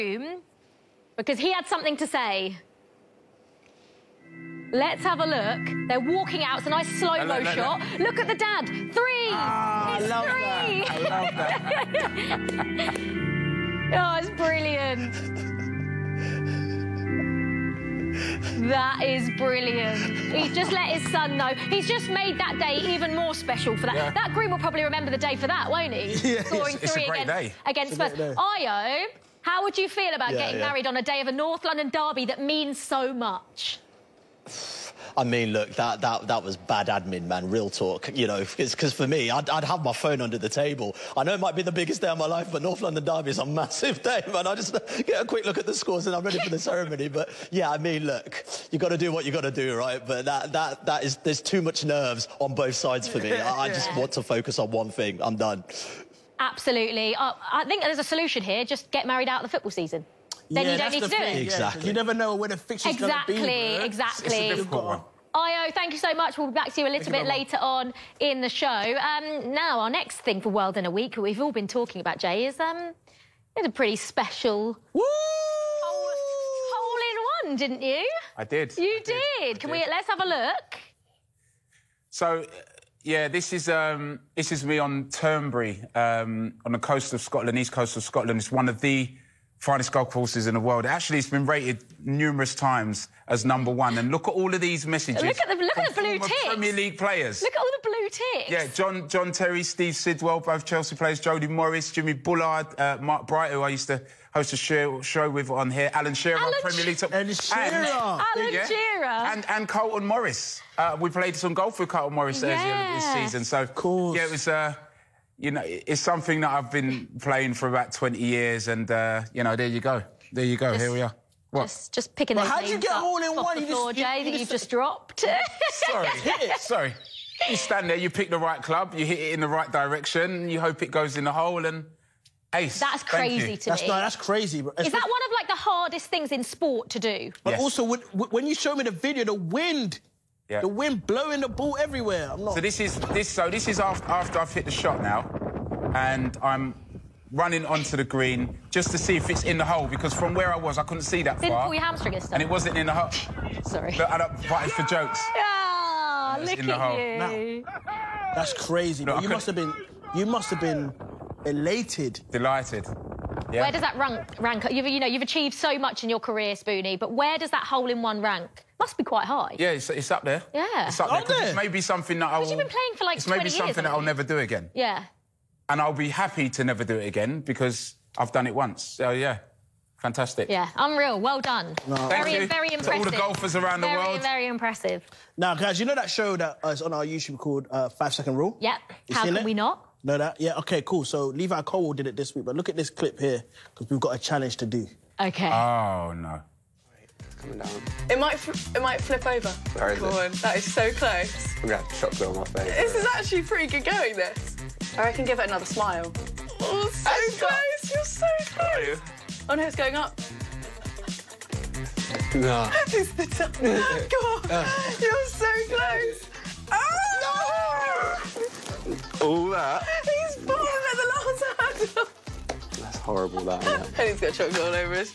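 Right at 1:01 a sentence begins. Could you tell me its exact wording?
You never know where the fixture's exactly, going to be.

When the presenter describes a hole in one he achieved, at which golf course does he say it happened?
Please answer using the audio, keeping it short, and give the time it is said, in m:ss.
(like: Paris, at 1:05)
Turnberry, at 1:25.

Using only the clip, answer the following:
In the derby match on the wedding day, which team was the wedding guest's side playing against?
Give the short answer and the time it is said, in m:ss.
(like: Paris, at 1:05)
Spurs, at 0:27.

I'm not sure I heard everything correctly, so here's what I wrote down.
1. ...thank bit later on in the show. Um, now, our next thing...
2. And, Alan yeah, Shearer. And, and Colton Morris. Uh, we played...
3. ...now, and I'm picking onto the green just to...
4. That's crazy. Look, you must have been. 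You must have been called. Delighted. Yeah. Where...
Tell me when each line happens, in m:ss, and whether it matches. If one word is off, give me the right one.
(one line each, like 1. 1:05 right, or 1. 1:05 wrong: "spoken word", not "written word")
1. 1:07 right
2. 1:47 right
3. 2:25 wrong: "running", not "picking"
4. 2:38 wrong: "elated", not "called".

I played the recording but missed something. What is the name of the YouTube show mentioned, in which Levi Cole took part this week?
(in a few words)
Five Second Rule.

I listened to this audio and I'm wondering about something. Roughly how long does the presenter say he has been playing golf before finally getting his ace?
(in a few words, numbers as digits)
20 years.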